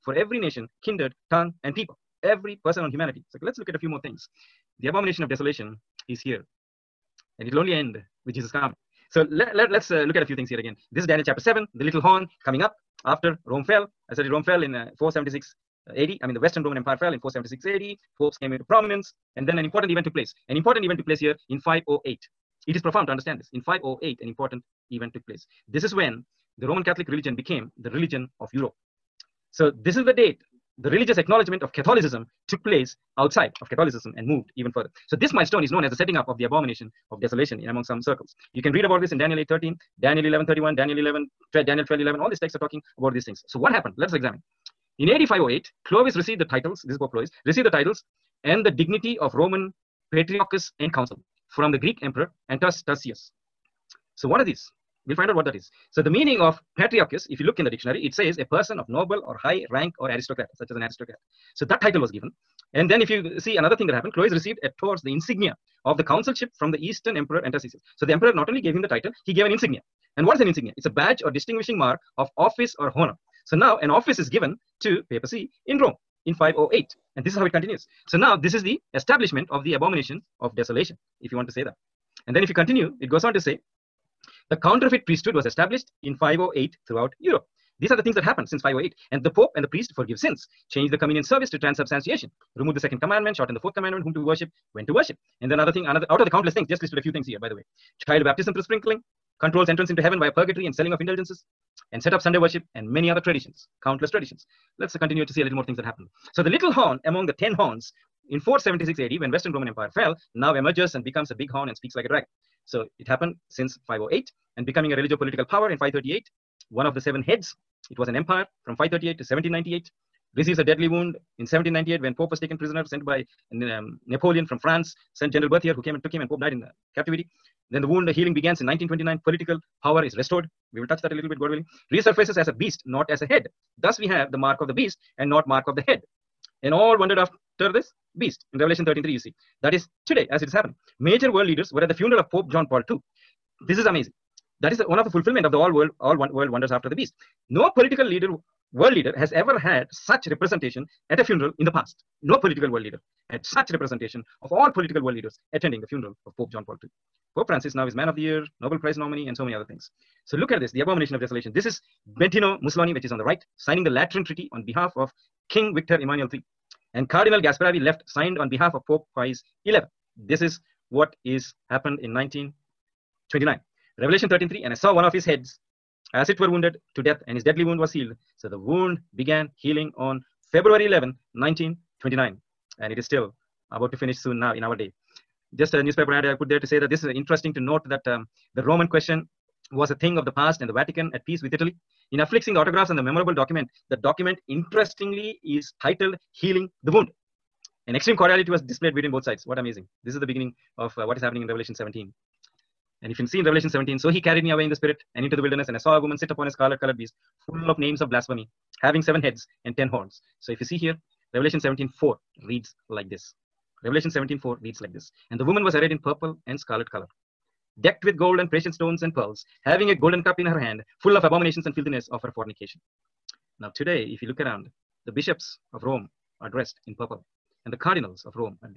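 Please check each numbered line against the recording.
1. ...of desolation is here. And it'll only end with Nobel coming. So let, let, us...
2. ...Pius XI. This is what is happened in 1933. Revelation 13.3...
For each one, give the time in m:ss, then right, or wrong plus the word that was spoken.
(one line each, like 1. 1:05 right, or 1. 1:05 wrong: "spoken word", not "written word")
1. 0:05 wrong: "Jesus", not "Nobel"
2. 2:49 wrong: "1929", not "1933".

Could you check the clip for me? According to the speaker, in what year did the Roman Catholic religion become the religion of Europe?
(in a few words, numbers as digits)
508.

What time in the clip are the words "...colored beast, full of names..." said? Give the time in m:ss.
3:26.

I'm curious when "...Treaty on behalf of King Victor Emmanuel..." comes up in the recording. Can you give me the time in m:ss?
2:44.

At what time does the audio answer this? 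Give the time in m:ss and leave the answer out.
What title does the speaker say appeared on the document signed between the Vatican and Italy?
3:16.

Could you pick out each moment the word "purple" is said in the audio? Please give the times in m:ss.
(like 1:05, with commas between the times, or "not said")
3:35, 3:46.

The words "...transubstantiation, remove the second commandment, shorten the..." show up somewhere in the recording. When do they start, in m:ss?
1:31.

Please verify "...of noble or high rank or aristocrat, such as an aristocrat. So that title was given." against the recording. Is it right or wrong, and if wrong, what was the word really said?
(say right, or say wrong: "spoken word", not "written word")
right.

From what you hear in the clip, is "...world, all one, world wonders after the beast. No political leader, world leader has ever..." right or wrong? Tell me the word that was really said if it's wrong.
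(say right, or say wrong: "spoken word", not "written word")
right.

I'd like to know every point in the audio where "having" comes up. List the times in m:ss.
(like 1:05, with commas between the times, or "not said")
3:28, 3:39.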